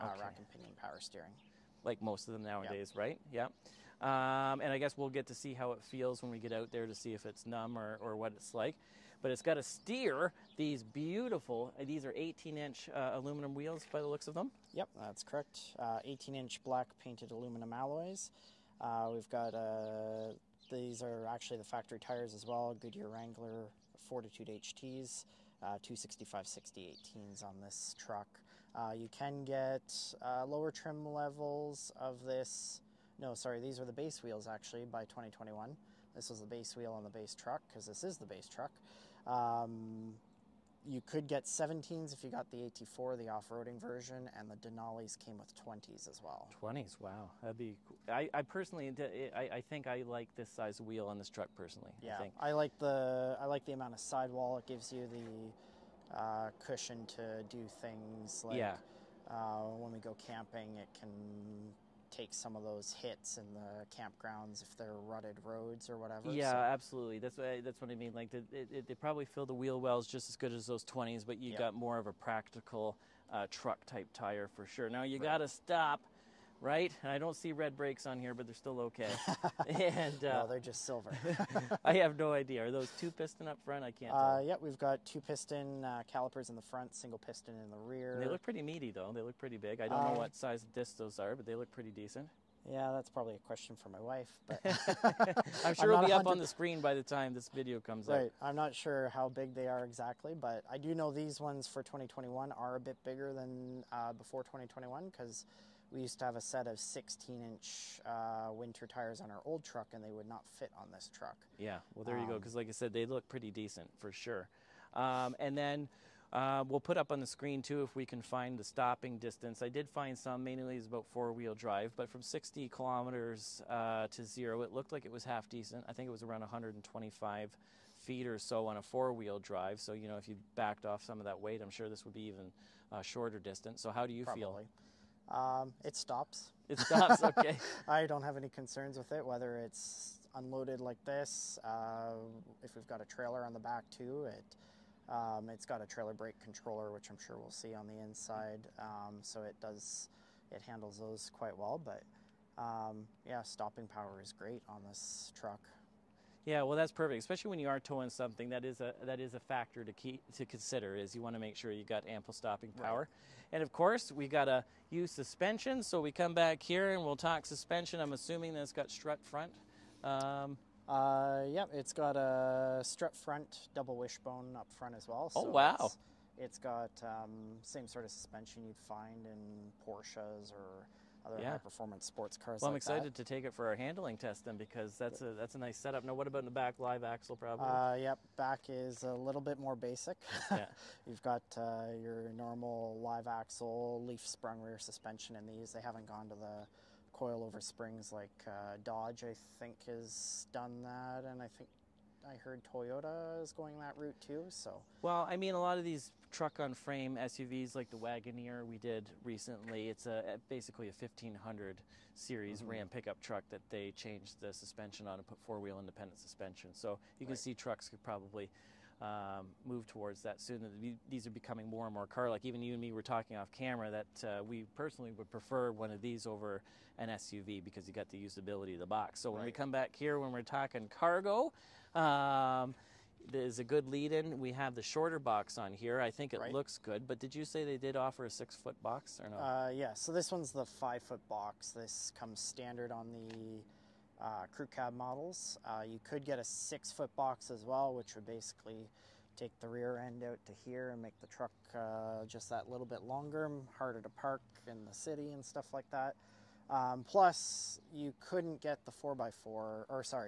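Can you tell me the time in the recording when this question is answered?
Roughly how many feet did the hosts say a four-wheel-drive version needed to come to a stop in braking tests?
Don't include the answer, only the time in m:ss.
2:06.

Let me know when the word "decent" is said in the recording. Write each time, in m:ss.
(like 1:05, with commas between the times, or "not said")
1:31, 1:53, 2:05.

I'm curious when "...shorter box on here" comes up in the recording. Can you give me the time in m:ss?
3:54.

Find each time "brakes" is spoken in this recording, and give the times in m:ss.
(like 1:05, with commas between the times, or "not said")
1:17, 2:26.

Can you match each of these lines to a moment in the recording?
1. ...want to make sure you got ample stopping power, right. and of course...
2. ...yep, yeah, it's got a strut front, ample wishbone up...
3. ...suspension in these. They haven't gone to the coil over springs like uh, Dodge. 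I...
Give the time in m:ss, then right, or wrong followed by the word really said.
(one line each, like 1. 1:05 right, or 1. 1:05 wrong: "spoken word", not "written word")
1. 2:41 right
2. 2:51 wrong: "double", not "ample"
3. 3:14 right.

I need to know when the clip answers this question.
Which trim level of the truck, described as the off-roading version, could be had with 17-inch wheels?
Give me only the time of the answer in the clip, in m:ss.
0:42.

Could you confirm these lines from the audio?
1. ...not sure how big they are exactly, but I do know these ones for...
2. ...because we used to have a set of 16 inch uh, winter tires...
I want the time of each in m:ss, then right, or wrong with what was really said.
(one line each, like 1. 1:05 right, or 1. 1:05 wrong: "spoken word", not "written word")
1. 1:38 right
2. 1:45 right.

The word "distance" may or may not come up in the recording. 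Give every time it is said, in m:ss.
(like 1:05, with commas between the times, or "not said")
1:59, 2:13.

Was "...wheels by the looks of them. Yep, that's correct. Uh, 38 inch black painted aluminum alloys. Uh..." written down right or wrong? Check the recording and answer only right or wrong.
wrong.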